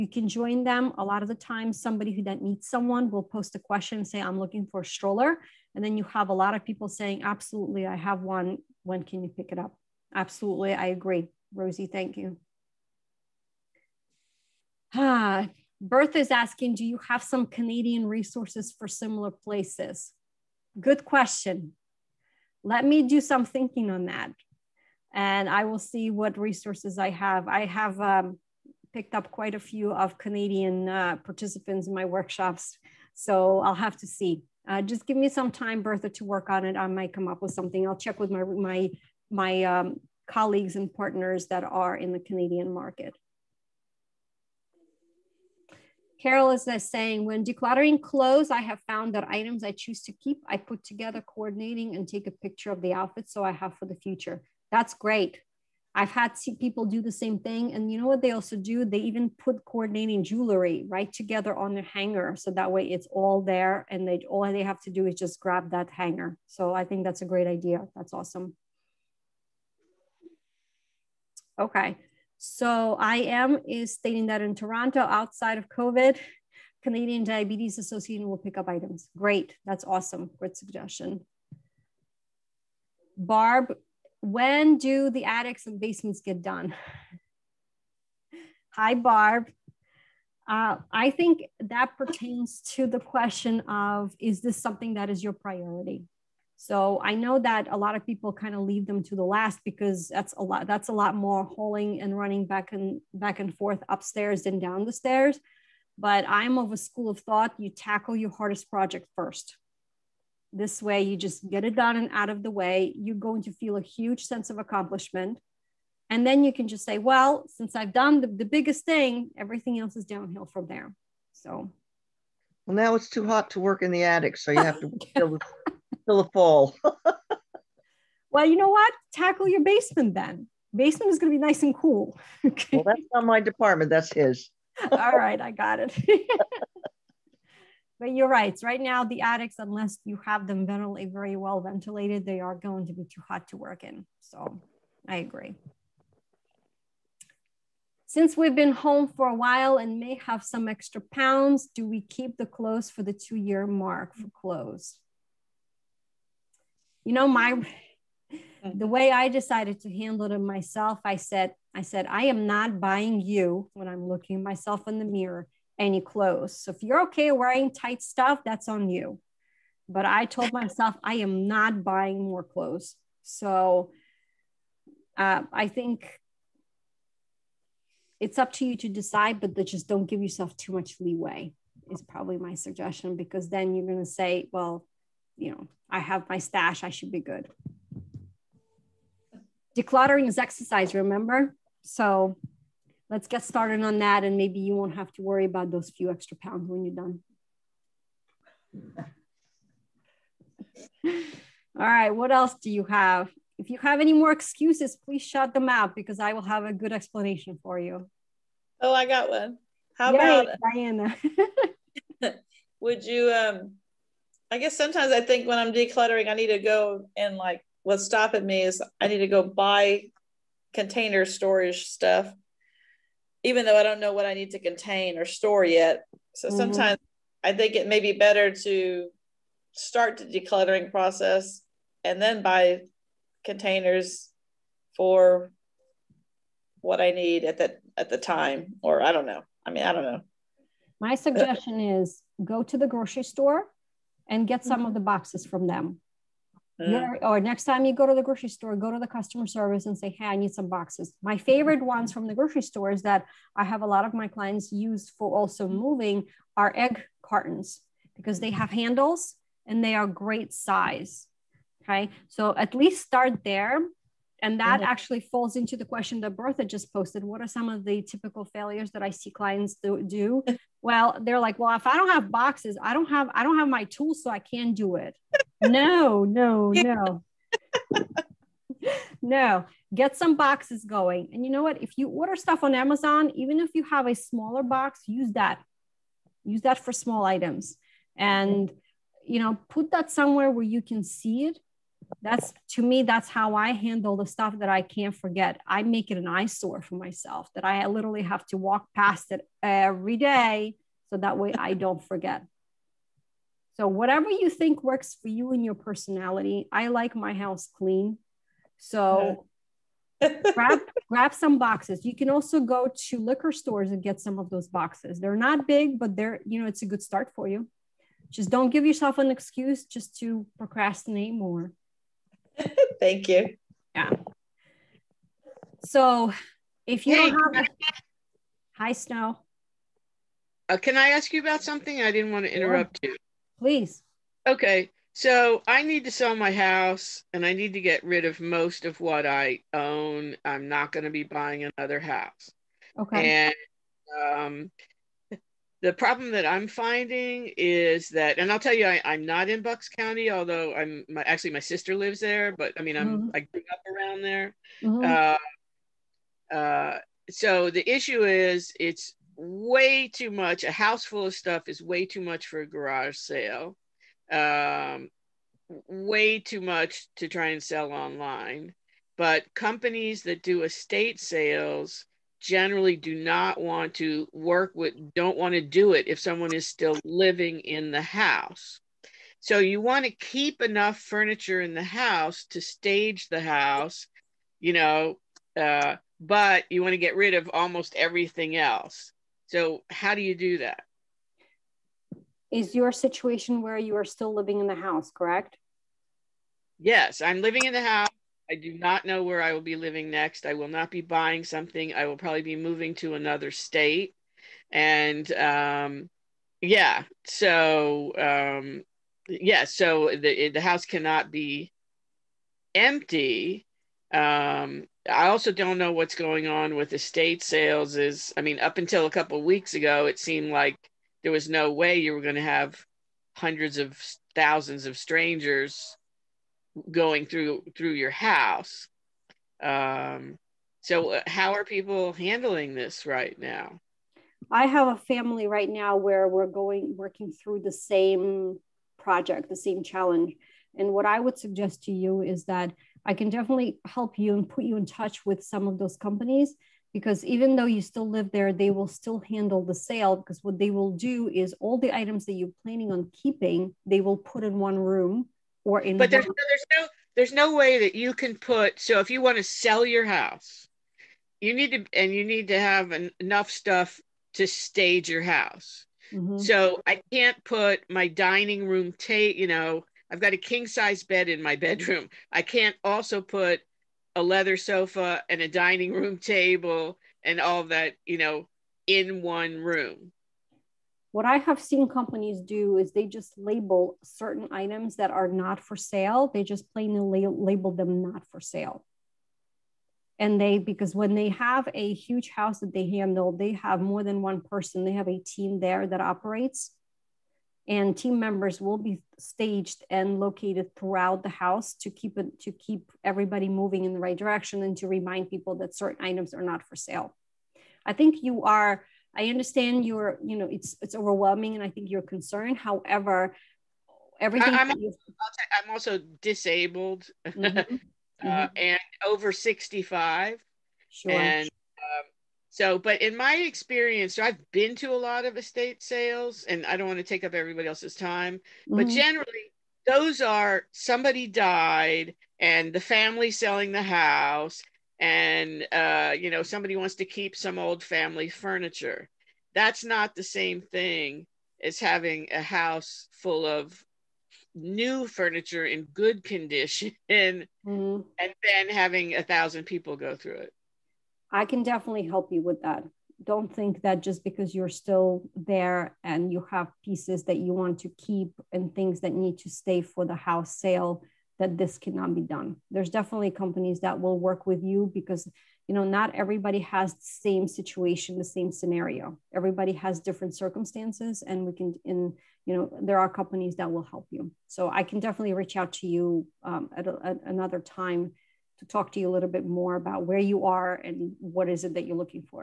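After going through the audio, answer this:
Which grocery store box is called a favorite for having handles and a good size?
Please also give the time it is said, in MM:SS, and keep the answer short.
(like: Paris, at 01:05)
Egg cartons, at 04:16.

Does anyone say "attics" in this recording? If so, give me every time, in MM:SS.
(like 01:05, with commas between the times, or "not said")
01:25, 02:04, 02:19.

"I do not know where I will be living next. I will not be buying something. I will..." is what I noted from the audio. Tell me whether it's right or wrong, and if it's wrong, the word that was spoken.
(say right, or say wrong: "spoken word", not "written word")
right.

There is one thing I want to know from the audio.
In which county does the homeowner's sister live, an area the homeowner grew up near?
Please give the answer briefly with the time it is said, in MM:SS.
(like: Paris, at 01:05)
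Bucks County, at 05:49.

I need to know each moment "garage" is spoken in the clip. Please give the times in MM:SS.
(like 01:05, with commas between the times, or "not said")
06:02.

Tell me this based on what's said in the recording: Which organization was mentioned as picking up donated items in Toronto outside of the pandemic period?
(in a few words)
Canadian Diabetes Association.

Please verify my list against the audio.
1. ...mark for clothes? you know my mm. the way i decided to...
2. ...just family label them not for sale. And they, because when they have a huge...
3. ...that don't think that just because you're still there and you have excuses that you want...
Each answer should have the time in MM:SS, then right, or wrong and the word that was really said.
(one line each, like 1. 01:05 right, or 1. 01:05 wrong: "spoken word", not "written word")
1. 02:33 right
2. 08:06 wrong: "plainly", not "family"
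3. 09:12 wrong: "pieces", not "excuses".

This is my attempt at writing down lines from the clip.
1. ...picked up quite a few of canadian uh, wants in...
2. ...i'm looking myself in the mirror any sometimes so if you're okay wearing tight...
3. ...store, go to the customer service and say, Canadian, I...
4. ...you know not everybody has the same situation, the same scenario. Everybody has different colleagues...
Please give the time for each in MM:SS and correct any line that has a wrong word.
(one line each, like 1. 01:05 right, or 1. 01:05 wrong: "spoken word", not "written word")
1. 00:28 wrong: "participants", not "wants"
2. 02:43 wrong: "clothes", not "sometimes"
3. 04:08 wrong: "Hey", not "Canadian"
4. 09:25 wrong: "circumstances", not "colleagues".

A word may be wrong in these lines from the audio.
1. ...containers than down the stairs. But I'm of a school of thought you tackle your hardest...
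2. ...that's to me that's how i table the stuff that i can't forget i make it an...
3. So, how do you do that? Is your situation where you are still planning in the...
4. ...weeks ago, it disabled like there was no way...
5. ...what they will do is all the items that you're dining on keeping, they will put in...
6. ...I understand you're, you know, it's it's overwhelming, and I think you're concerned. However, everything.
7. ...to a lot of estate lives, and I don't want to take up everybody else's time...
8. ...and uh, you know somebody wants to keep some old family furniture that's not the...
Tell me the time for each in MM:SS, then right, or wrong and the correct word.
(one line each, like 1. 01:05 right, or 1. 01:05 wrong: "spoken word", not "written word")
1. 01:43 wrong: "upstairs", not "containers"
2. 04:52 wrong: "handle", not "table"
3. 06:29 wrong: "living", not "planning"
4. 06:59 wrong: "seemed", not "disabled"
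5. 07:30 wrong: "planning", not "dining"
6. 08:29 right
7. 08:44 wrong: "sales", not "lives"
8. 08:54 right.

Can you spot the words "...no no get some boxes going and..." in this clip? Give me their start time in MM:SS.
04:36.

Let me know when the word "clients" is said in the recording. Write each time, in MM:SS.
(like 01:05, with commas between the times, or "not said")
04:14, 04:29.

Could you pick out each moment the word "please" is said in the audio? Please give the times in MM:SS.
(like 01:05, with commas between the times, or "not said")
03:25, 05:33.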